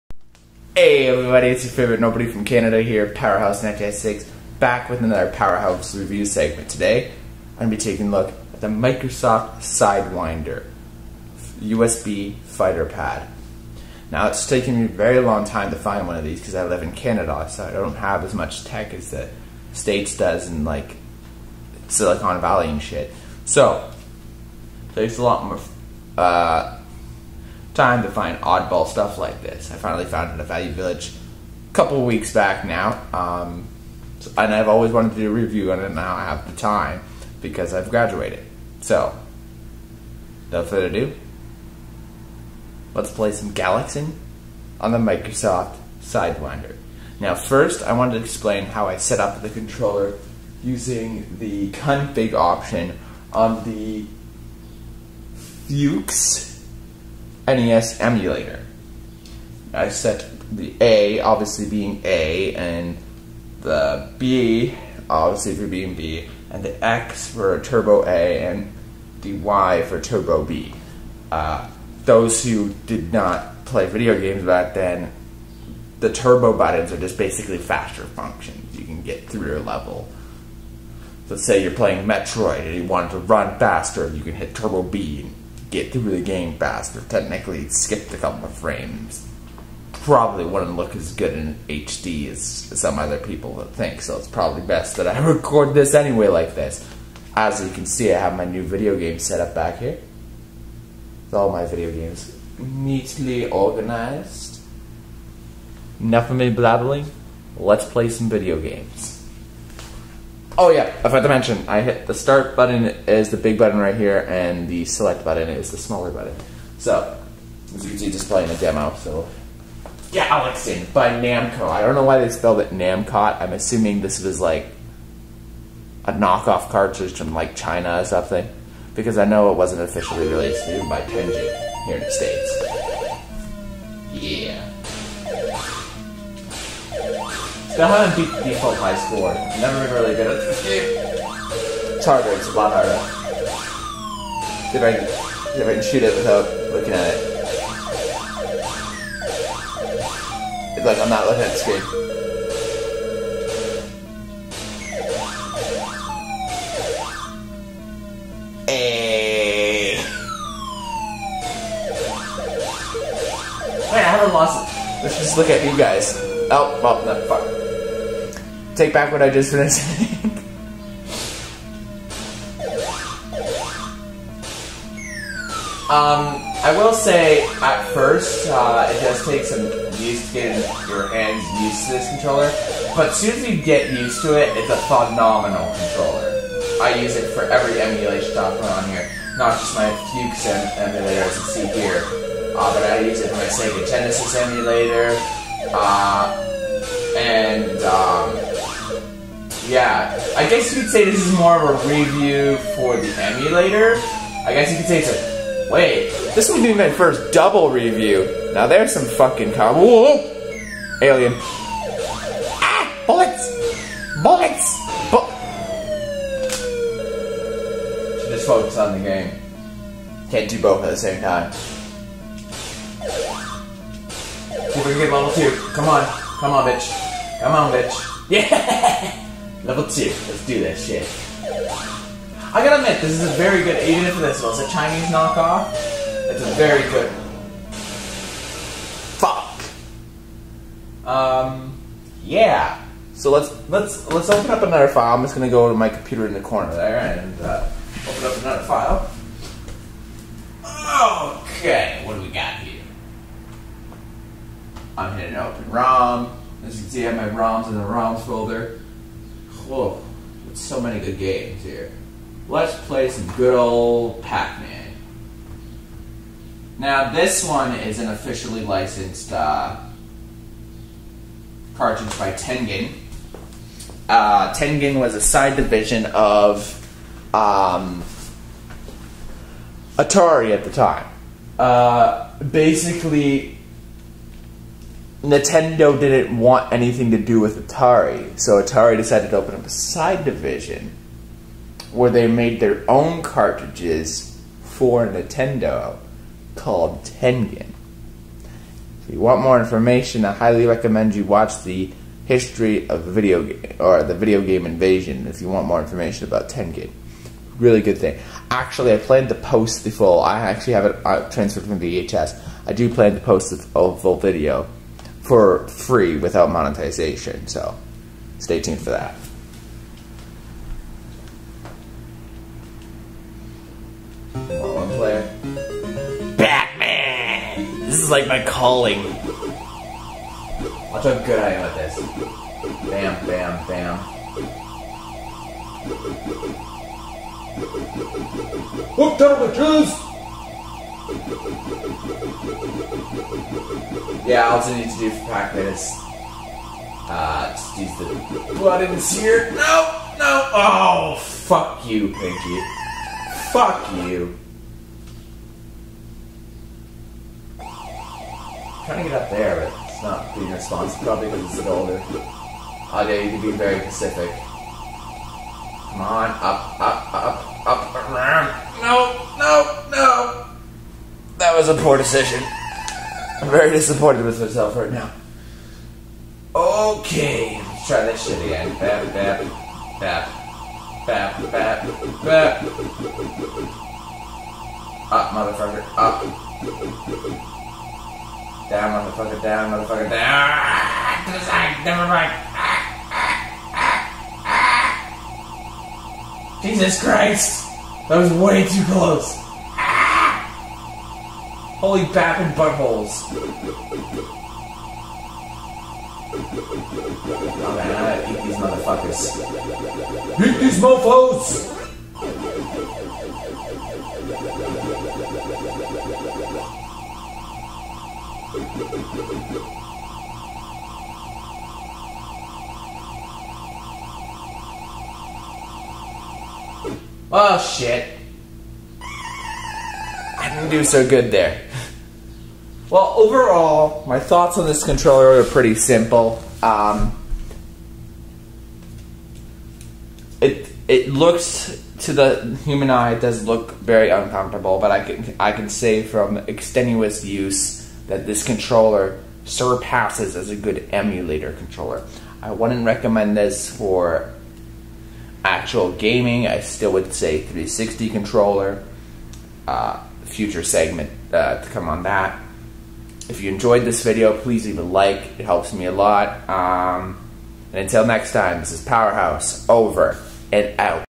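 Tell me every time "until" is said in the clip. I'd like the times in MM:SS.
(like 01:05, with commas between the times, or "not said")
07:47.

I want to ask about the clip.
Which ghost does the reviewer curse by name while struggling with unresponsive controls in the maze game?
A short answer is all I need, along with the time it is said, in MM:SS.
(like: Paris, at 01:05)
Pinky, at 05:52.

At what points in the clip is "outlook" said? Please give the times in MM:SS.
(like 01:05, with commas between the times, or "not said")
not said.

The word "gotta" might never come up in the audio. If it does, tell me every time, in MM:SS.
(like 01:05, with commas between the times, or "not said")
03:52, 06:48.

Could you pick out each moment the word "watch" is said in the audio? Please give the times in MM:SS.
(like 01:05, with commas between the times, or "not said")
05:01, 05:30.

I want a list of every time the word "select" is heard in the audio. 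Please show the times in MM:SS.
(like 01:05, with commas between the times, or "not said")
01:54.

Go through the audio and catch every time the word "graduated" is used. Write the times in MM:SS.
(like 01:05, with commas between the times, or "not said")
00:37.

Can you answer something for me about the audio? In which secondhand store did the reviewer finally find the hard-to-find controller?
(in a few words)
Value Village.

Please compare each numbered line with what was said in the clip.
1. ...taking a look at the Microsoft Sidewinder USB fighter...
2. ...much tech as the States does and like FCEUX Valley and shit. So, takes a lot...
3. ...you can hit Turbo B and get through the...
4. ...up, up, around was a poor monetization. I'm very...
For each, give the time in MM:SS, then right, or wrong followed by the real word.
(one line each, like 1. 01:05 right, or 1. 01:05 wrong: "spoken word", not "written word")
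1. 00:07 right
2. 00:18 wrong: "Silicon", not "FCEUX"
3. 01:24 right
4. 06:07 wrong: "decision", not "monetization".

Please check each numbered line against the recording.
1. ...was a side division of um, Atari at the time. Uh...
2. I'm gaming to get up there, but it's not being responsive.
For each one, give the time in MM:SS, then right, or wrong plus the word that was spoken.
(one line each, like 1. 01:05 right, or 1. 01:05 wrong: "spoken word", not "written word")
1. 04:34 right
2. 05:57 wrong: "trying", not "gaming".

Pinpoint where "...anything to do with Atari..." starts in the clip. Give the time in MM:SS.
04:46.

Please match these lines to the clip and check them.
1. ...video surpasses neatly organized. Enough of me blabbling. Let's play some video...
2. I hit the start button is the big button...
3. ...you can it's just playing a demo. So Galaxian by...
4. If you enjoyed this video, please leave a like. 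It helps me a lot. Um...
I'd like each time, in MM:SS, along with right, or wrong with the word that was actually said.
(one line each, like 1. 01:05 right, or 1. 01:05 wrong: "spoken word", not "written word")
1. 01:41 wrong: "games", not "surpasses"
2. 01:51 right
3. 01:57 right
4. 07:43 right.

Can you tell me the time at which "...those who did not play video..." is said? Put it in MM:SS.
01:12.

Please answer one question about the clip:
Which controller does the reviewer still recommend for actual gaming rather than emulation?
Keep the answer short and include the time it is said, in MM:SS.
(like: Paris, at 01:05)
360 controller, at 07:37.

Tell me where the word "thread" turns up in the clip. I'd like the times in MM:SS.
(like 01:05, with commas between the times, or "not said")
not said.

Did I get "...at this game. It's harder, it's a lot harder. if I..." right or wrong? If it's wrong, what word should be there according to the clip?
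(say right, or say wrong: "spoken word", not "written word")
right.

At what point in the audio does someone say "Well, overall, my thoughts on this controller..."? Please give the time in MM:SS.
07:12.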